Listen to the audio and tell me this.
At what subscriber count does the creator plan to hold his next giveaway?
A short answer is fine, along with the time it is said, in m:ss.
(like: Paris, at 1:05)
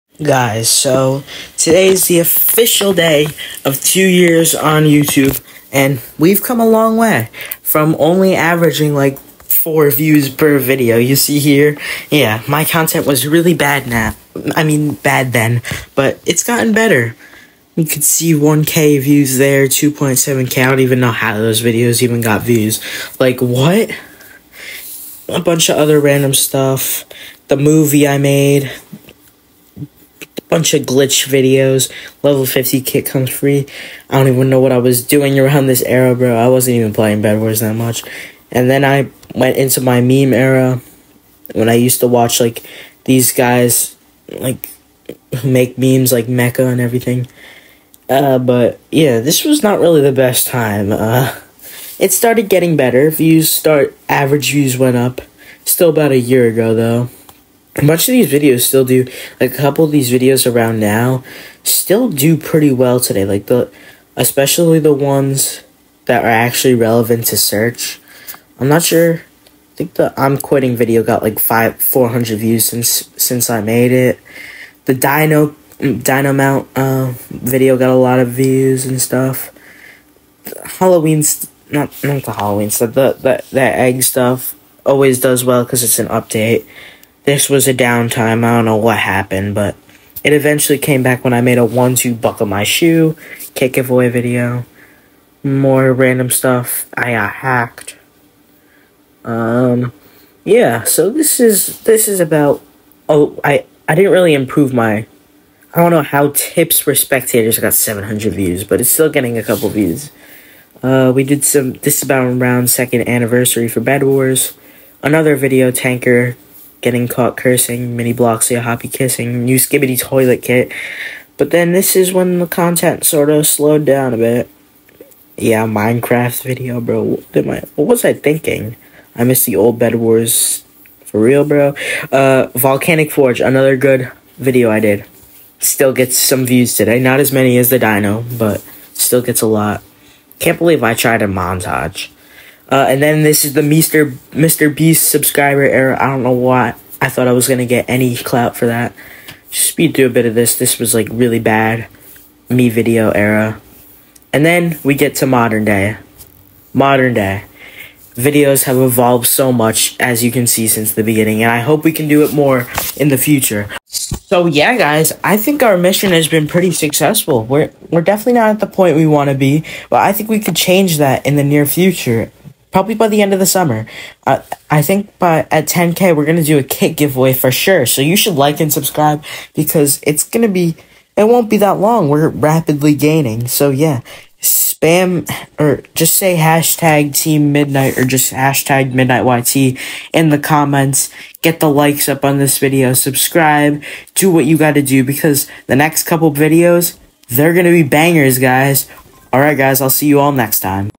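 10k, at 2:55.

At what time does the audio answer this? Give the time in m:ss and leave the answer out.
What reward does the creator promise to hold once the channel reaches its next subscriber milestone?
2:56.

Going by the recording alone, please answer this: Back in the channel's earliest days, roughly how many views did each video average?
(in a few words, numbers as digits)
4.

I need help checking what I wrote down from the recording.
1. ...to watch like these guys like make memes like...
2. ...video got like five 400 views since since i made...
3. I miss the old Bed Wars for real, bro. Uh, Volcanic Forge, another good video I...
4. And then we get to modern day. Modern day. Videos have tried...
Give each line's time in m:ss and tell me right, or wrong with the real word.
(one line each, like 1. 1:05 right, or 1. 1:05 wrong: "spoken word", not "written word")
1. 0:42 right
2. 1:10 right
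3. 2:09 right
4. 2:34 wrong: "evolved", not "tried".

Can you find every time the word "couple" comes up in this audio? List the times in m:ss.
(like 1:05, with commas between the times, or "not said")
0:59, 1:49, 3:16.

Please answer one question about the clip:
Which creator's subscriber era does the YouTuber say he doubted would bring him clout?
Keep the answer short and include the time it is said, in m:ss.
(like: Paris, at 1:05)
Mr. Beast, at 2:24.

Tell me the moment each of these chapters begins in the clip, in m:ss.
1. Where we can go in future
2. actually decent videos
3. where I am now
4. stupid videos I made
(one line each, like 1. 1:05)
1. 2:47
2. 0:57
3. 2:35
4. 0:31.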